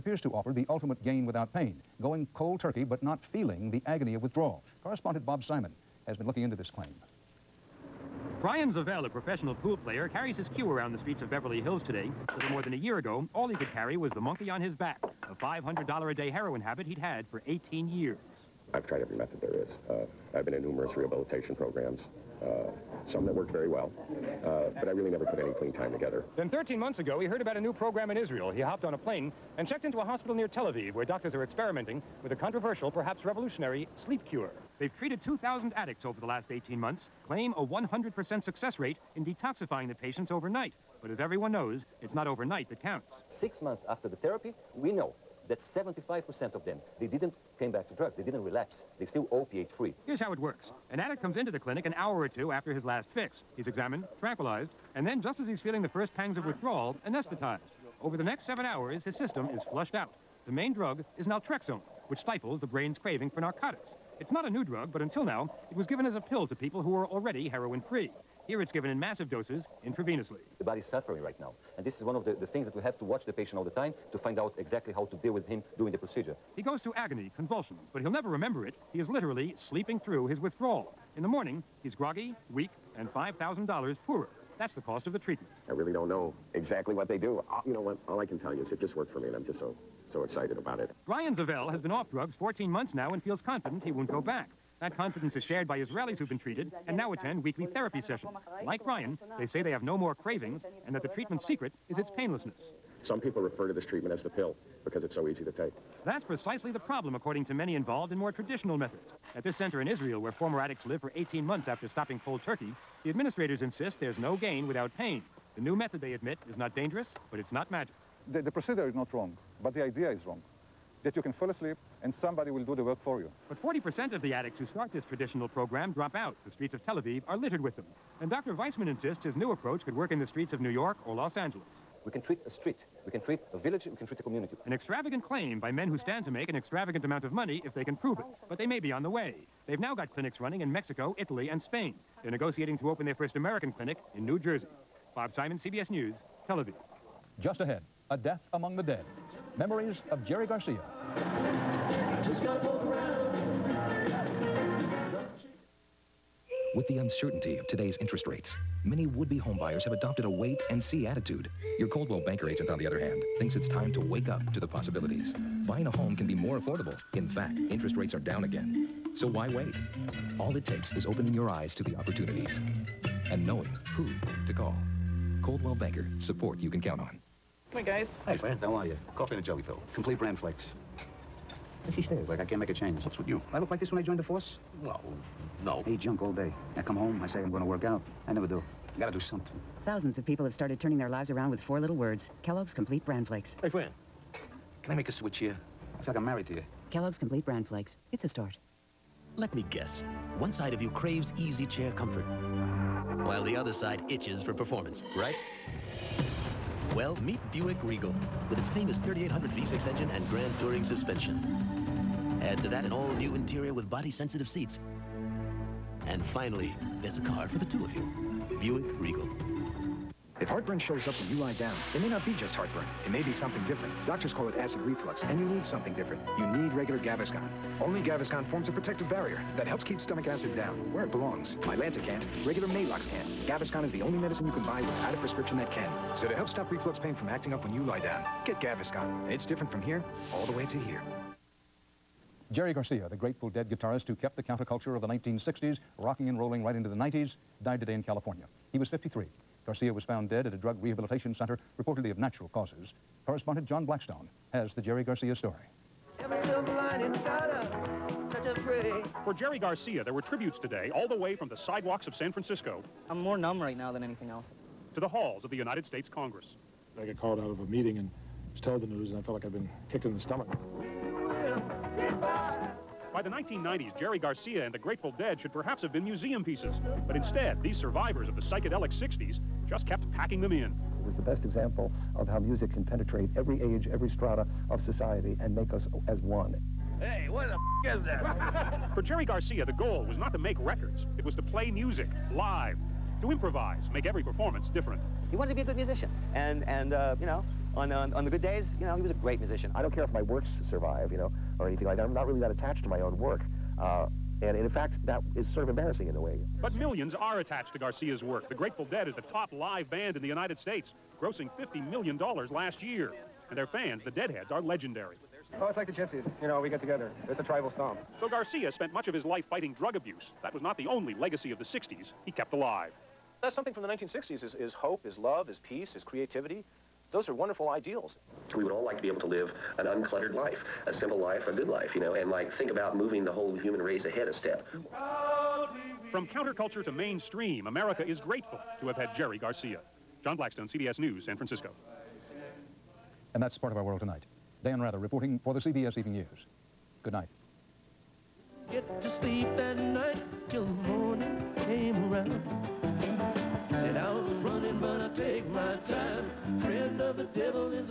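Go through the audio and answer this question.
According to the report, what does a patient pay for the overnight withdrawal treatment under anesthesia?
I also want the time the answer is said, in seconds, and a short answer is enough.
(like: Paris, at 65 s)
$5,000, at 83 s.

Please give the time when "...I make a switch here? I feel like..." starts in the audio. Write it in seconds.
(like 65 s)
194 s.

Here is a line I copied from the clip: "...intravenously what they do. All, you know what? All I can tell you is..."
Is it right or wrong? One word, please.
wrong.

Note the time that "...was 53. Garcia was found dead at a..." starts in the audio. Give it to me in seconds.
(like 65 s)
248 s.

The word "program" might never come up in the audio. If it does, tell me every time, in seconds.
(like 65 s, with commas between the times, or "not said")
21 s, 27 s, 125 s.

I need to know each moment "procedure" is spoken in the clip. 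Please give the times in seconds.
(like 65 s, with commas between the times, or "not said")
75 s, 118 s.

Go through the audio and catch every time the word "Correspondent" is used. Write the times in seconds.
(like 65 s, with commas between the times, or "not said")
4 s, 253 s.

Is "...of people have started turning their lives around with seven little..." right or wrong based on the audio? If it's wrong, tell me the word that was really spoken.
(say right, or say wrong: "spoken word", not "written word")
wrong: "four", not "seven".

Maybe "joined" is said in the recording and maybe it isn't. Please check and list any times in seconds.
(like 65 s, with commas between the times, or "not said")
184 s.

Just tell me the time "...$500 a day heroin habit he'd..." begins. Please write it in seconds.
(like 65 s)
15 s.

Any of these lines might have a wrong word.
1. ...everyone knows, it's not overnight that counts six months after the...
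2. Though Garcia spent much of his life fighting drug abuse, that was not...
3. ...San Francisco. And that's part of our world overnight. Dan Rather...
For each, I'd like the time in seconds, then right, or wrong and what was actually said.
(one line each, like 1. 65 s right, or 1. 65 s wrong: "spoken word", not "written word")
1. 41 s right
2. 318 s right
3. 341 s wrong: "tonight", not "overnight".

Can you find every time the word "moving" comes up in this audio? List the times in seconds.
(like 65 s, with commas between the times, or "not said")
332 s.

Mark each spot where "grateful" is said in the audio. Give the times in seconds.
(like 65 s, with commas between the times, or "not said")
243 s, 274 s, 308 s, 338 s.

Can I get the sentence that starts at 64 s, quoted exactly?
It's not a new drug, but until now, it was given as a pill to people who were already heroin-free.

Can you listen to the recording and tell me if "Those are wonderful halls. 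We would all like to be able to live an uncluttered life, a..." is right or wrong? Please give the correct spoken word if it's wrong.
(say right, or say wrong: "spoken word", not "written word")
wrong: "ideals", not "halls".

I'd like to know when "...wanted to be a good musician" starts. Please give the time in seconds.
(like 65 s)
295 s.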